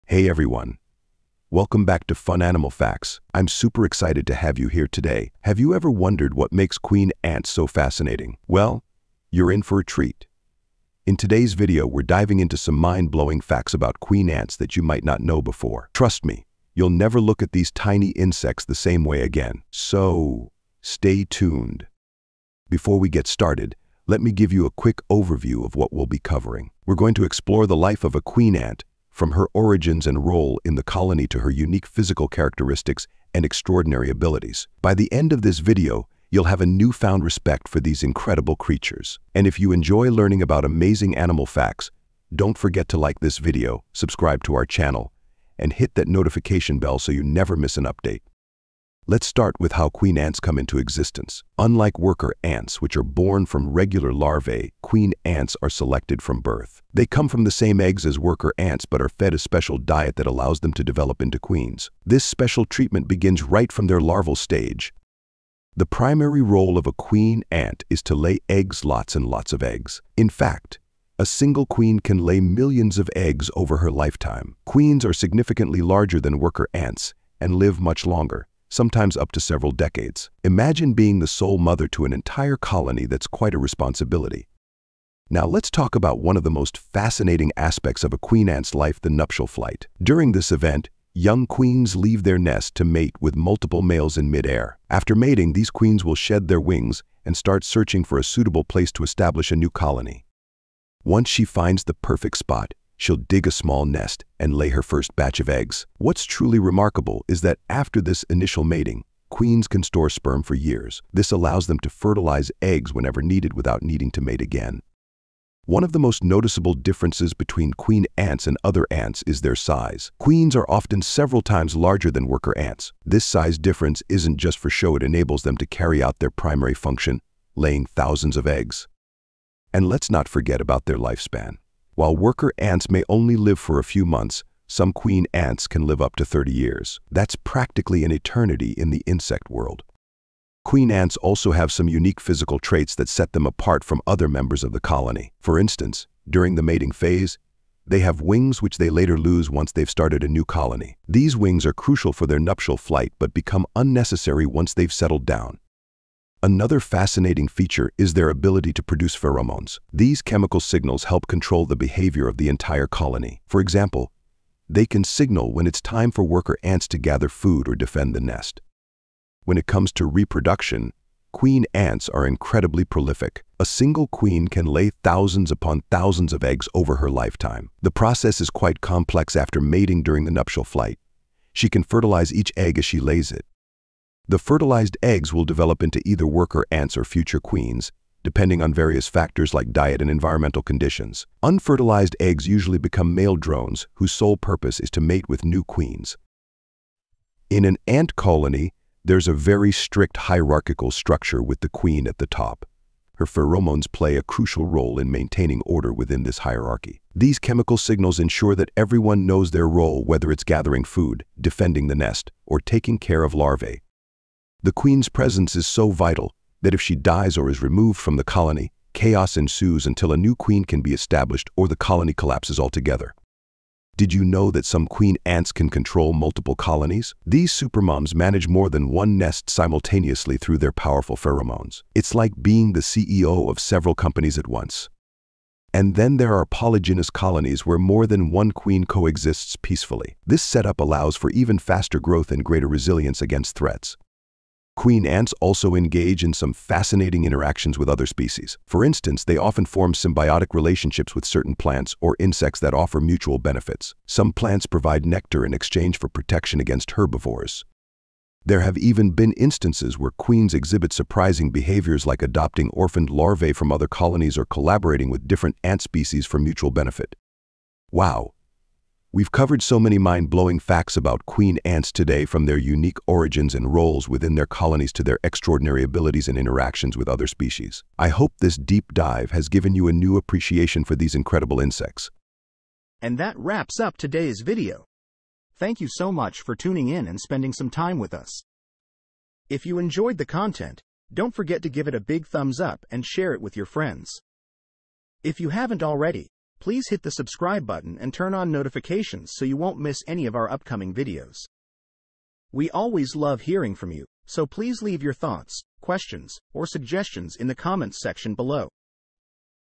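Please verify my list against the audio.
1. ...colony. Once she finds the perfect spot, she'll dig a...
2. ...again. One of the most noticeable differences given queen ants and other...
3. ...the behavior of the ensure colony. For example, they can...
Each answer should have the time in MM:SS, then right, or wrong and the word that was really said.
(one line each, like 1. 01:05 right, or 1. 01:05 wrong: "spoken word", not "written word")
1. 01:39 right
2. 01:54 wrong: "between", not "given"
3. 02:41 wrong: "entire", not "ensure".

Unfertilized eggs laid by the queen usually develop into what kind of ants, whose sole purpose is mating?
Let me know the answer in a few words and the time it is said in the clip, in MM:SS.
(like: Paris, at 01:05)
Male drones, at 03:13.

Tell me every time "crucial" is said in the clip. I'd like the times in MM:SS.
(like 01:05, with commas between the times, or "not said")
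02:31, 03:24.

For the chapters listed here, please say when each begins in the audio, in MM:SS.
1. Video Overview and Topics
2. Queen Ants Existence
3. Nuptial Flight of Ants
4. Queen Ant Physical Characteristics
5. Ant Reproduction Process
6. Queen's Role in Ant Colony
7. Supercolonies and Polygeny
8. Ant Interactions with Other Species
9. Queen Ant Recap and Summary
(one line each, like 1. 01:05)
1. 00:24
2. 00:49
3. 01:25
4. 01:55
5. 02:50
6. 03:18
7. 03:44
8. 04:05
9. 04:28.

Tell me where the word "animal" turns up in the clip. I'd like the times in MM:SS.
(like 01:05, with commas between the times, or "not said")
00:02, 00:41.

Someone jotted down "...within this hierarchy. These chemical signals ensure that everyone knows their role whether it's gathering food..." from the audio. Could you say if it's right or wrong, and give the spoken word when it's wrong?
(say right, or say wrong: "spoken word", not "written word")
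right.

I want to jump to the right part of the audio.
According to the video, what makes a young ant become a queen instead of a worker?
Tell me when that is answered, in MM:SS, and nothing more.
00:59.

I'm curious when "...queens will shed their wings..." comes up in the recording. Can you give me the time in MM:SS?
01:35.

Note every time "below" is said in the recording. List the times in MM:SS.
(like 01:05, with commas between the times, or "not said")
05:08.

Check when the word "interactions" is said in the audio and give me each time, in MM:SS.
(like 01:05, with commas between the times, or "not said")
04:07, 04:36.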